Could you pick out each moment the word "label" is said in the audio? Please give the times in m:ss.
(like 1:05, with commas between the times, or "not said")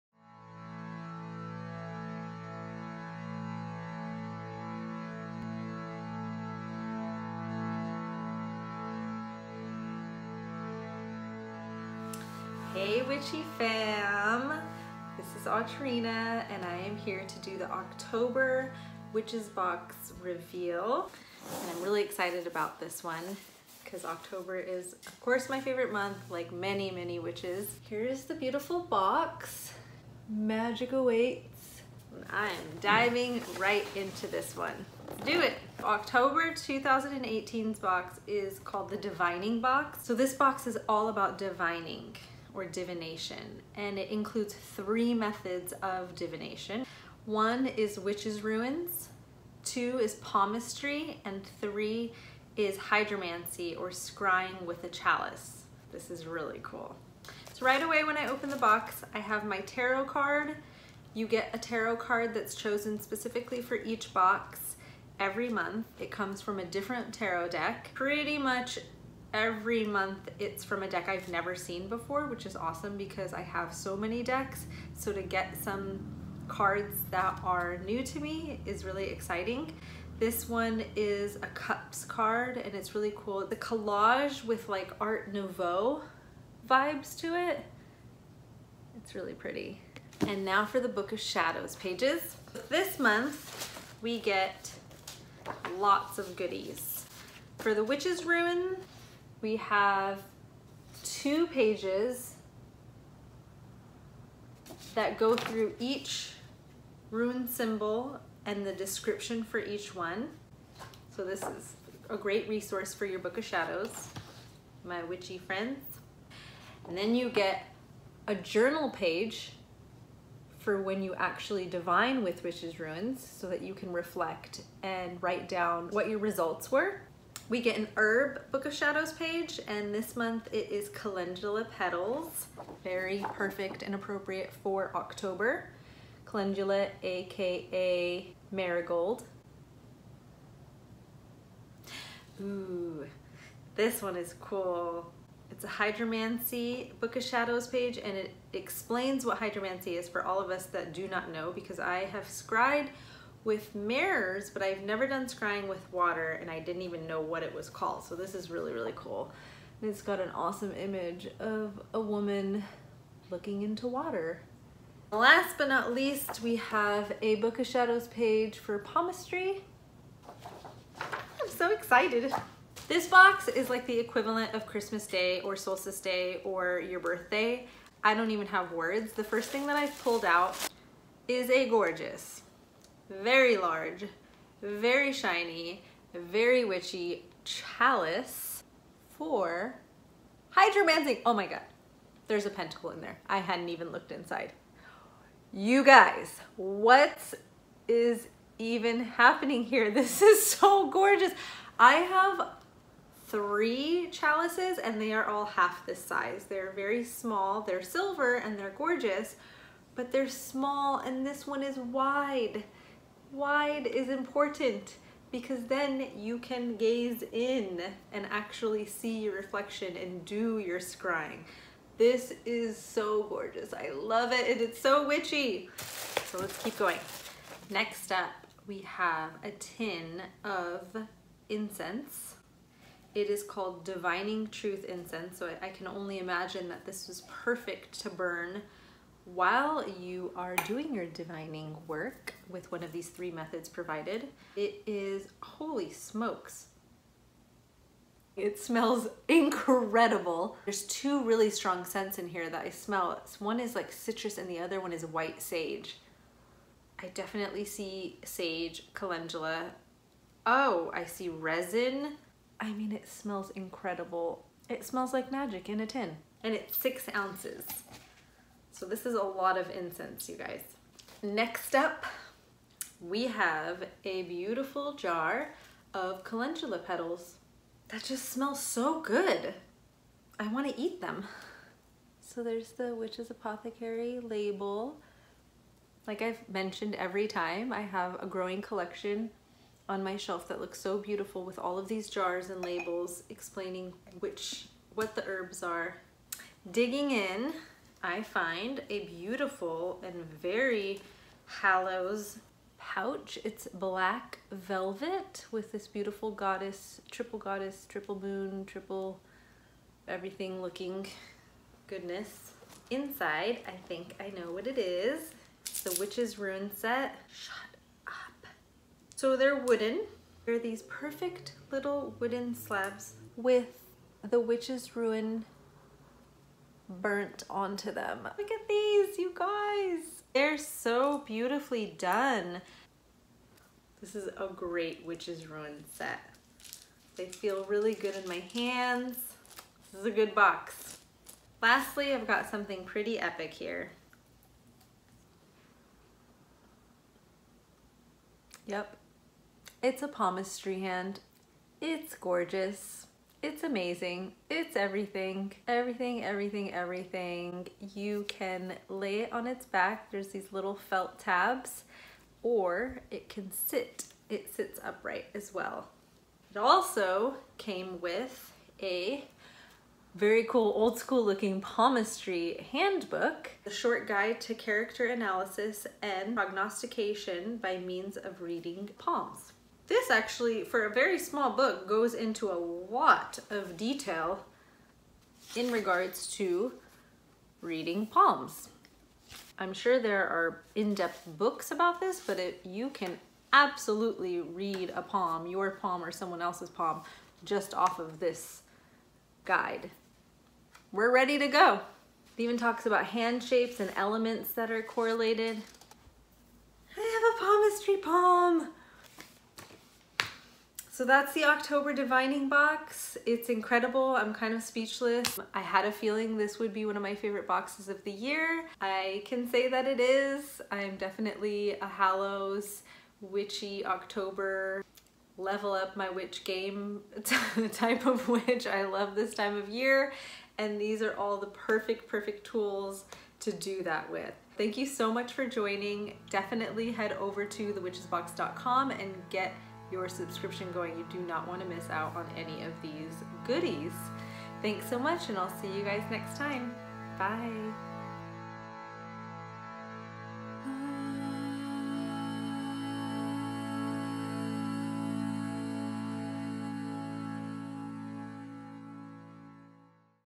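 4:44, 4:52.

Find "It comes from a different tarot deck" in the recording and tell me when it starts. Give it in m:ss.
1:05.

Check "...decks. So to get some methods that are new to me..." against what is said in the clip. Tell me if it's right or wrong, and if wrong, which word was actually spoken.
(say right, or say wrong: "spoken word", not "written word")
wrong: "cards", not "methods".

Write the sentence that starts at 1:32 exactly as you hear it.
This month we get lots of goodies.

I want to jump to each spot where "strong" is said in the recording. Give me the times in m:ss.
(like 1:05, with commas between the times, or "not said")
4:11.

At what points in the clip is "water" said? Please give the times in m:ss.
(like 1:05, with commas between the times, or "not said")
2:35, 2:43.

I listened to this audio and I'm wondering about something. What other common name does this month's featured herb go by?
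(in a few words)
Marigold.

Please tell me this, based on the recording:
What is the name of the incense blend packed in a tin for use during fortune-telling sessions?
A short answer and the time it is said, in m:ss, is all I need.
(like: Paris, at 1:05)
Divining Truth Incense, at 3:53.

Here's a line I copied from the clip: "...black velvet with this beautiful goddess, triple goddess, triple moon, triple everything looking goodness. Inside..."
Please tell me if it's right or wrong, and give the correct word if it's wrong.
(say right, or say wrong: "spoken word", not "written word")
right.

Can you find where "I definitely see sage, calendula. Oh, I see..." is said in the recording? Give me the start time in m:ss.
4:17.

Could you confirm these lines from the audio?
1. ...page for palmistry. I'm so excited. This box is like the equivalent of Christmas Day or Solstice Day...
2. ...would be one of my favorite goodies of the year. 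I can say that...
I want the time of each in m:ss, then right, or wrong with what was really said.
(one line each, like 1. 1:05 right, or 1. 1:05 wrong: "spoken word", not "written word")
1. 2:48 right
2. 6:56 wrong: "boxes", not "goodies".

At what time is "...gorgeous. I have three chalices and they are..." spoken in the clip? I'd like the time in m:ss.
3:20.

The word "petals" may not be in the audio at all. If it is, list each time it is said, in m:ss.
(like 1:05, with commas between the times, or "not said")
2:11, 4:36.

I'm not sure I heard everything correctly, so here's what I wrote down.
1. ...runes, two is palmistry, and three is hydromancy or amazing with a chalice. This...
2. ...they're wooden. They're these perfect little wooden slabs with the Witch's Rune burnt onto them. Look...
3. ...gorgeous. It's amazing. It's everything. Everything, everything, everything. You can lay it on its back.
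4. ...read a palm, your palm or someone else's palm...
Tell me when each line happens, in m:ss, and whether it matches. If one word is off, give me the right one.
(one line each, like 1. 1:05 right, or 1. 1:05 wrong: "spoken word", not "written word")
1. 0:48 wrong: "scrying", not "amazing"
2. 5:19 right
3. 5:52 right
4. 6:34 right.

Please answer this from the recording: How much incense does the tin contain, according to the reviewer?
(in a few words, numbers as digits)
6 ounces.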